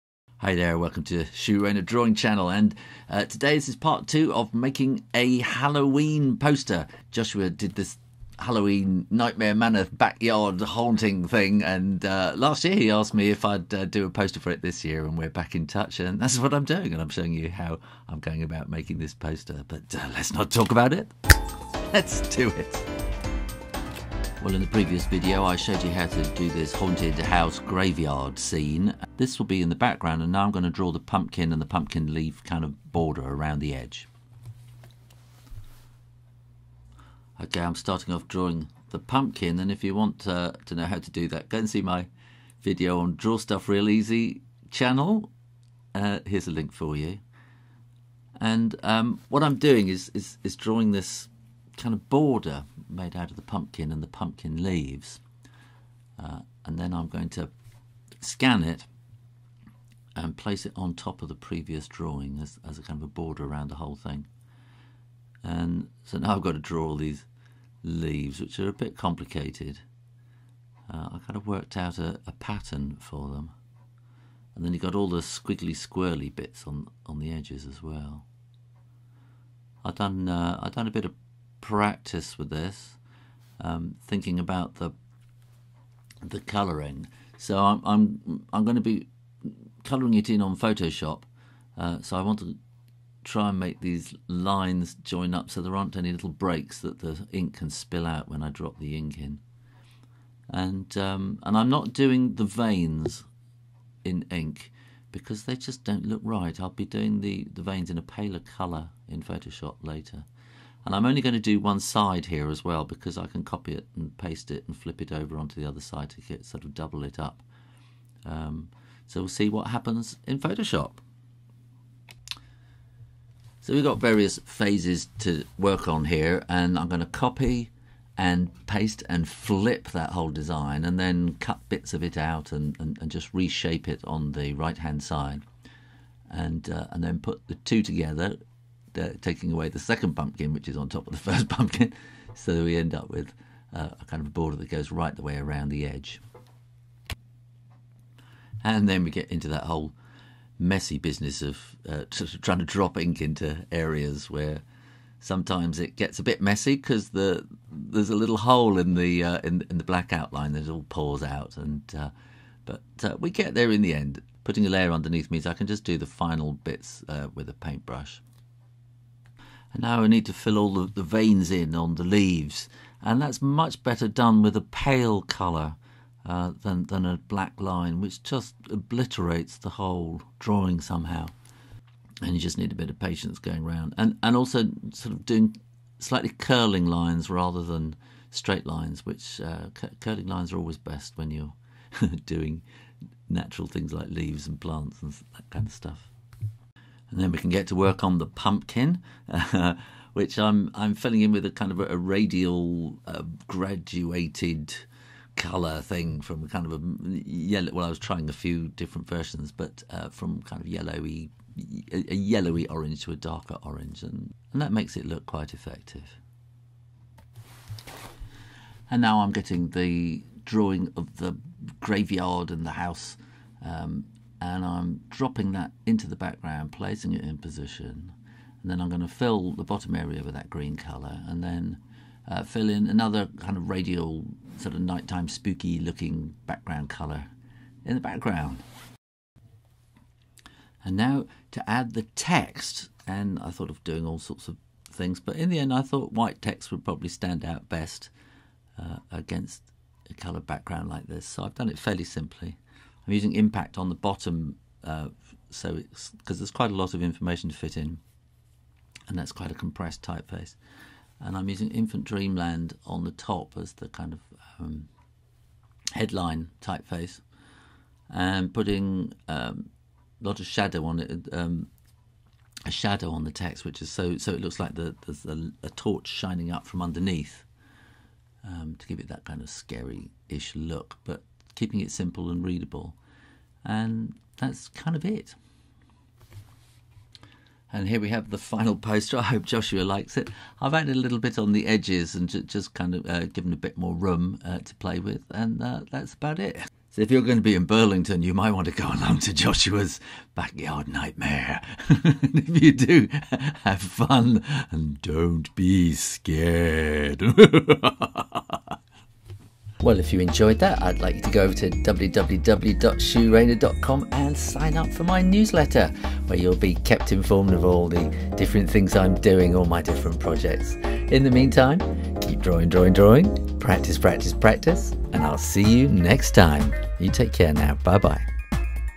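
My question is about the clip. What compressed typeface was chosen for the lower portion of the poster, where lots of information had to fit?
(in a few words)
Impact.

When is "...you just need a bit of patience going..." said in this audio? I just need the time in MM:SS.
03:02.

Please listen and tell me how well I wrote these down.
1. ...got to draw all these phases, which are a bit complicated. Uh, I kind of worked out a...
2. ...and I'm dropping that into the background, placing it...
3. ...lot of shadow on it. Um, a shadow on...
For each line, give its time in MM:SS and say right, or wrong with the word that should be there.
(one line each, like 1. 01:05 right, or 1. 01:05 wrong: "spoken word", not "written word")
1. 01:06 wrong: "leaves", not "phases"
2. 03:44 right
3. 04:30 right.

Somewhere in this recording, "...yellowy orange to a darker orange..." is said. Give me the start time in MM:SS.
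03:32.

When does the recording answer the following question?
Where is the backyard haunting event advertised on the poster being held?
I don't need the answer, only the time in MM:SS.
04:57.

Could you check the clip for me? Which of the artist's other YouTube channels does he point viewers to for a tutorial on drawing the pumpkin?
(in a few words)
Draw Stuff Real Easy.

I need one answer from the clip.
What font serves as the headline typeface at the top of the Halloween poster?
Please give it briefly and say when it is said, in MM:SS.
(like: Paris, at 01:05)
Infant Dreamland, at 04:21.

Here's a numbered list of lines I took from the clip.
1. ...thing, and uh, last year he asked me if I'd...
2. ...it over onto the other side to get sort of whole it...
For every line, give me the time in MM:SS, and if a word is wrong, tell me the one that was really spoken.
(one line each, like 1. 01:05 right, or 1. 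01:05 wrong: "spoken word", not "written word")
1. 00:11 right
2. 01:55 wrong: "double", not "whole".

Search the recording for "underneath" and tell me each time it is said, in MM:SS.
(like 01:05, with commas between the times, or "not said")
02:44, 04:36.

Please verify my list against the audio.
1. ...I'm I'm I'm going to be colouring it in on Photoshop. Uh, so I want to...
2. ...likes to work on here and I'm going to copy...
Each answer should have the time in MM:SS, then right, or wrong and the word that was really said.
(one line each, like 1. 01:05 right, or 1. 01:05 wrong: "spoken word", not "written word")
1. 01:27 right
2. 02:04 wrong: "phases", not "likes".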